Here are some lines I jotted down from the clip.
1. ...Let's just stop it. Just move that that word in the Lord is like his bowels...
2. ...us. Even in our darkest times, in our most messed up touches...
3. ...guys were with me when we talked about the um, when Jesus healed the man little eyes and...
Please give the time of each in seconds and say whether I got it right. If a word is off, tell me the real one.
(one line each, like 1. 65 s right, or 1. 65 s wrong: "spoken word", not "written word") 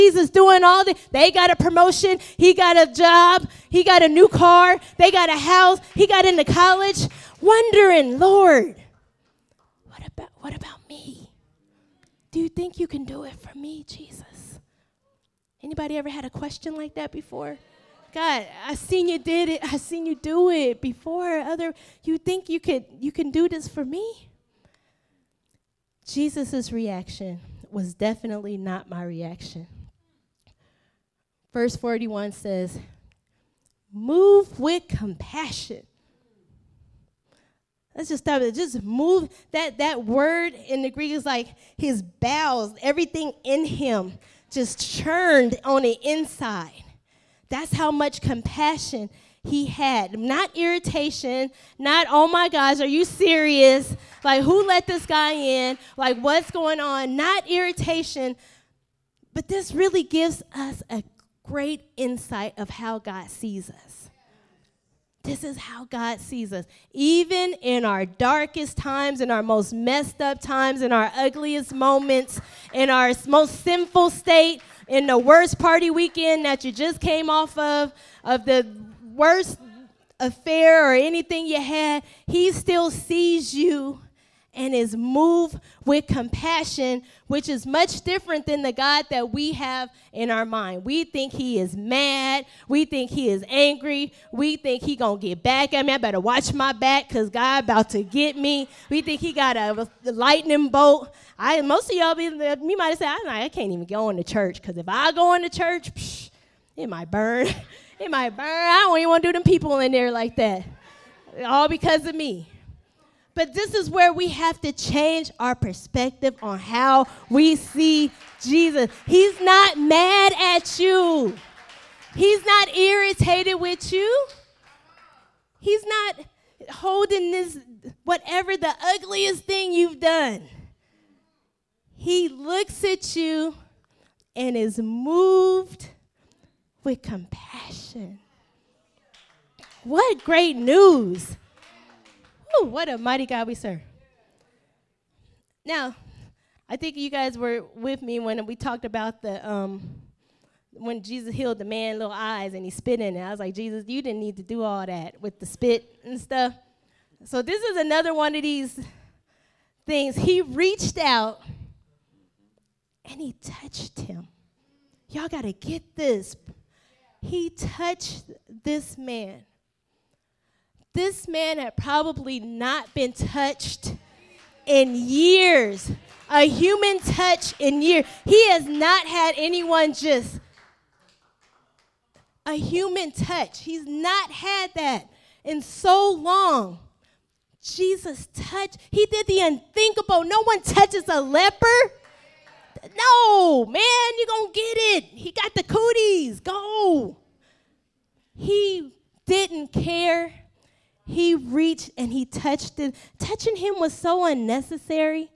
1. 37 s wrong: "Greek", not "Lord"
2. 66 s wrong: "times", not "touches"
3. 147 s right.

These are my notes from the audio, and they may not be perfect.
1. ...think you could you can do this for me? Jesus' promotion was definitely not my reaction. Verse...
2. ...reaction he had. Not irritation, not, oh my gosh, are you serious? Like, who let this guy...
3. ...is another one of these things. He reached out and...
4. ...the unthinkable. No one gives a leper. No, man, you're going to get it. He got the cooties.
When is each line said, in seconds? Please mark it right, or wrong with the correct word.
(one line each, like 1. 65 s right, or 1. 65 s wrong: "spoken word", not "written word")
1. 22 s wrong: "reaction", not "promotion"
2. 48 s wrong: "compassion", not "reaction"
3. 157 s right
4. 189 s wrong: "touches", not "gives".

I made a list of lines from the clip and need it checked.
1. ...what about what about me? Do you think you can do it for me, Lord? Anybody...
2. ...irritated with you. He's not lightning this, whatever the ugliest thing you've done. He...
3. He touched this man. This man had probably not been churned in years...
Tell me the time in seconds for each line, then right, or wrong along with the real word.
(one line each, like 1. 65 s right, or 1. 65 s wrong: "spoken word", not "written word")
1. 9 s wrong: "Jesus", not "Lord"
2. 122 s wrong: "holding", not "lightning"
3. 167 s wrong: "touched", not "churned".